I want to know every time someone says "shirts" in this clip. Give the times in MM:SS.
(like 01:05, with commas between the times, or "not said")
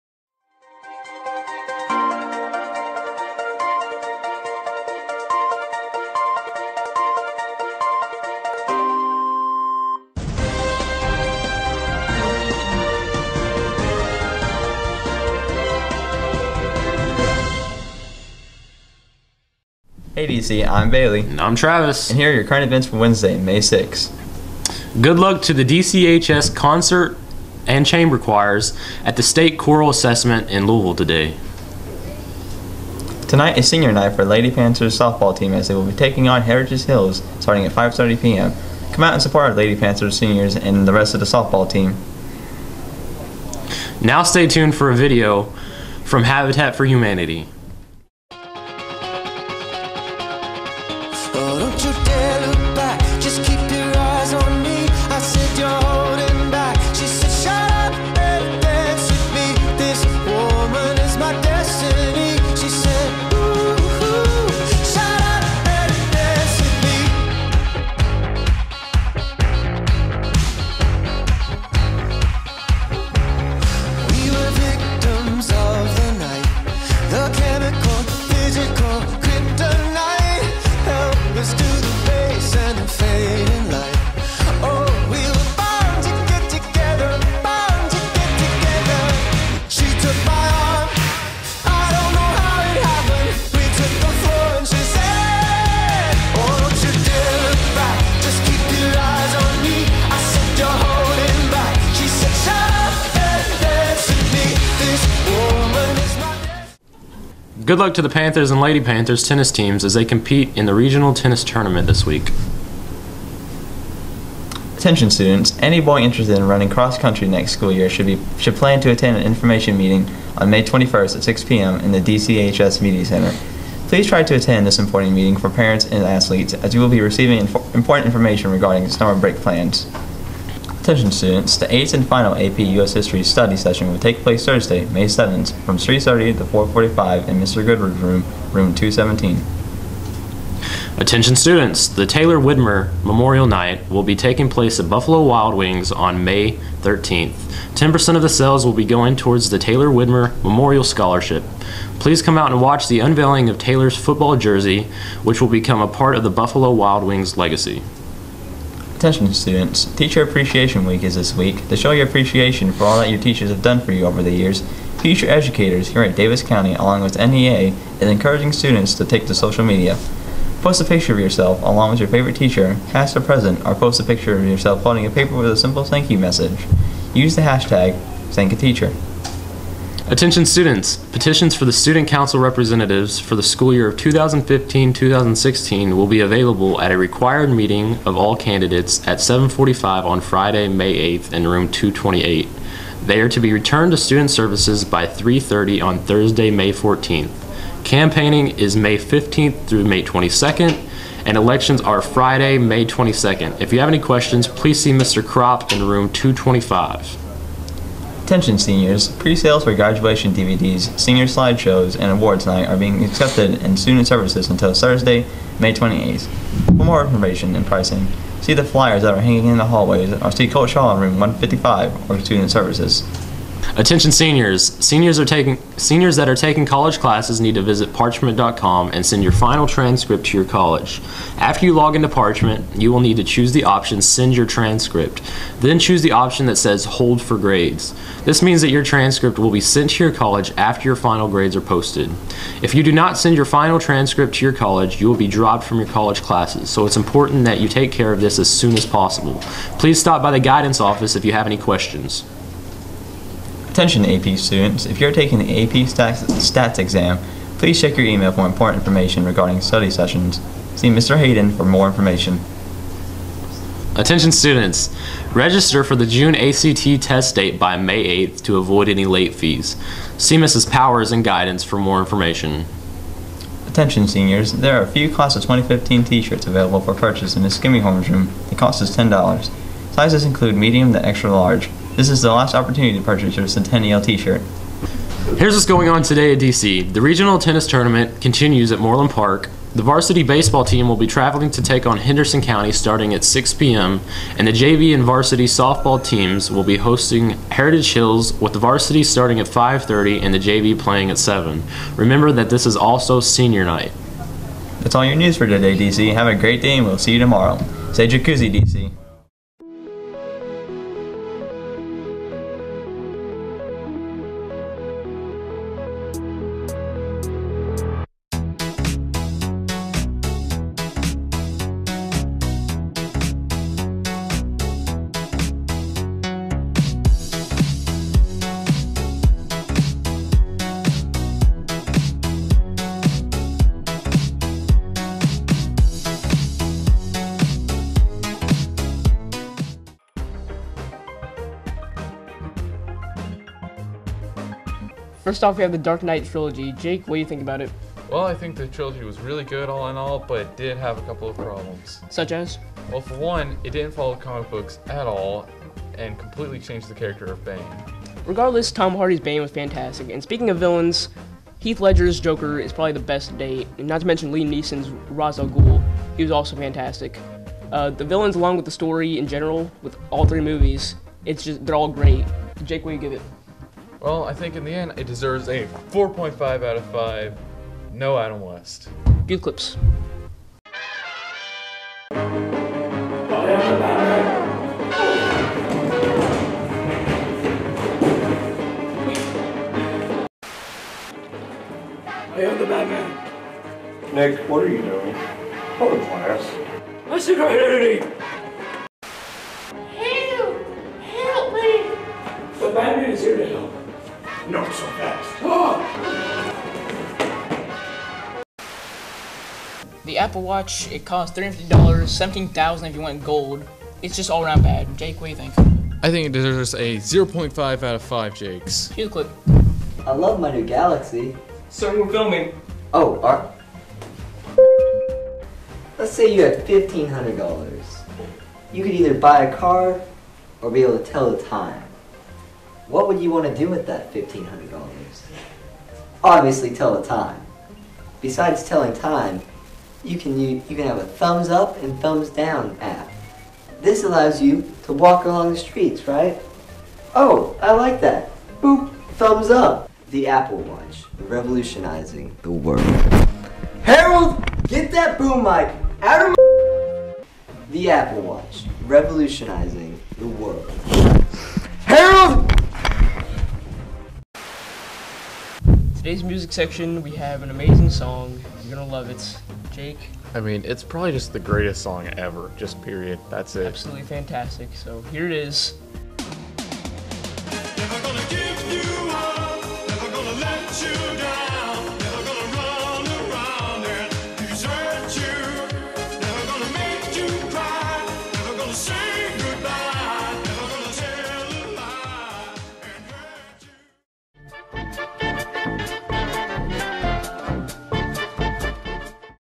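04:36, 04:44.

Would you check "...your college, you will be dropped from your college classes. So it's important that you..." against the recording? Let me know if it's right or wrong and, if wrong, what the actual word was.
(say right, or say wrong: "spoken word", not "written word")
right.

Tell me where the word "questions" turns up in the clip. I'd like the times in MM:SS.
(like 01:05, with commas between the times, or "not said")
03:23, 04:11.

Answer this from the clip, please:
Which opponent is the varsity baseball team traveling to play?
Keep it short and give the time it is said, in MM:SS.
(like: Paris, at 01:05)
Henderson County, at 04:51.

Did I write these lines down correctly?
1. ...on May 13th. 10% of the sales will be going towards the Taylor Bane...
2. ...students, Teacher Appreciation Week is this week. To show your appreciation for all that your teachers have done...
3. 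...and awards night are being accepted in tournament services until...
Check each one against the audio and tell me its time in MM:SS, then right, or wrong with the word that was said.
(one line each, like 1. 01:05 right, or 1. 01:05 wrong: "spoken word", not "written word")
1. 02:25 wrong: "Widmer", not "Bane"
2. 02:39 right
3. 03:31 wrong: "student", not "tournament".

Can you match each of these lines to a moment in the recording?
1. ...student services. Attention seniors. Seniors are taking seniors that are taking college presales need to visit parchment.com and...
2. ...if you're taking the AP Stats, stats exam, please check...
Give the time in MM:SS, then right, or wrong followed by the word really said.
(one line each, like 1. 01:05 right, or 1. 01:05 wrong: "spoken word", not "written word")
1. 03:42 wrong: "classes", not "presales"
2. 04:14 right.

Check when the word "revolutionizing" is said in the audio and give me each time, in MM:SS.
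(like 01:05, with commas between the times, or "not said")
07:31, 07:38.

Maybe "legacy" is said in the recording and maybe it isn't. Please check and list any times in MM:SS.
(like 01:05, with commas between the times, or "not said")
02:37.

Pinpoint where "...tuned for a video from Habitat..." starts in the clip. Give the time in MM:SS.
00:44.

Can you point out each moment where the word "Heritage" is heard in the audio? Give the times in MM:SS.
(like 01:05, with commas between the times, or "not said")
00:36, 04:57.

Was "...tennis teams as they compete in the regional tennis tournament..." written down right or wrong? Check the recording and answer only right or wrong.
right.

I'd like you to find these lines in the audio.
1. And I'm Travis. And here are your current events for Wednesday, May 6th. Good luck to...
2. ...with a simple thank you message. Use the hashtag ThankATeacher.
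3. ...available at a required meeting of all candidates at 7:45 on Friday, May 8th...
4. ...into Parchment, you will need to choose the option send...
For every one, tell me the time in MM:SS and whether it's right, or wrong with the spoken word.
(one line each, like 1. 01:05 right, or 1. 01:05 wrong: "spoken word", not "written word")
1. 00:21 right
2. 02:55 right
3. 03:06 right
4. 03:51 right.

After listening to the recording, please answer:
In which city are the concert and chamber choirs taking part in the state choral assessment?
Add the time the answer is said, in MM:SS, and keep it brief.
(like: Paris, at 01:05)
Louisville, at 00:30.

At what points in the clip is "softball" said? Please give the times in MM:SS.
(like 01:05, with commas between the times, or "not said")
00:34, 00:41, 04:55.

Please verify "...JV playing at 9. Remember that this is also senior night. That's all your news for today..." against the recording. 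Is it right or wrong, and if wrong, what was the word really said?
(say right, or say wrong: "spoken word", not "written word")
wrong: "7", not "9".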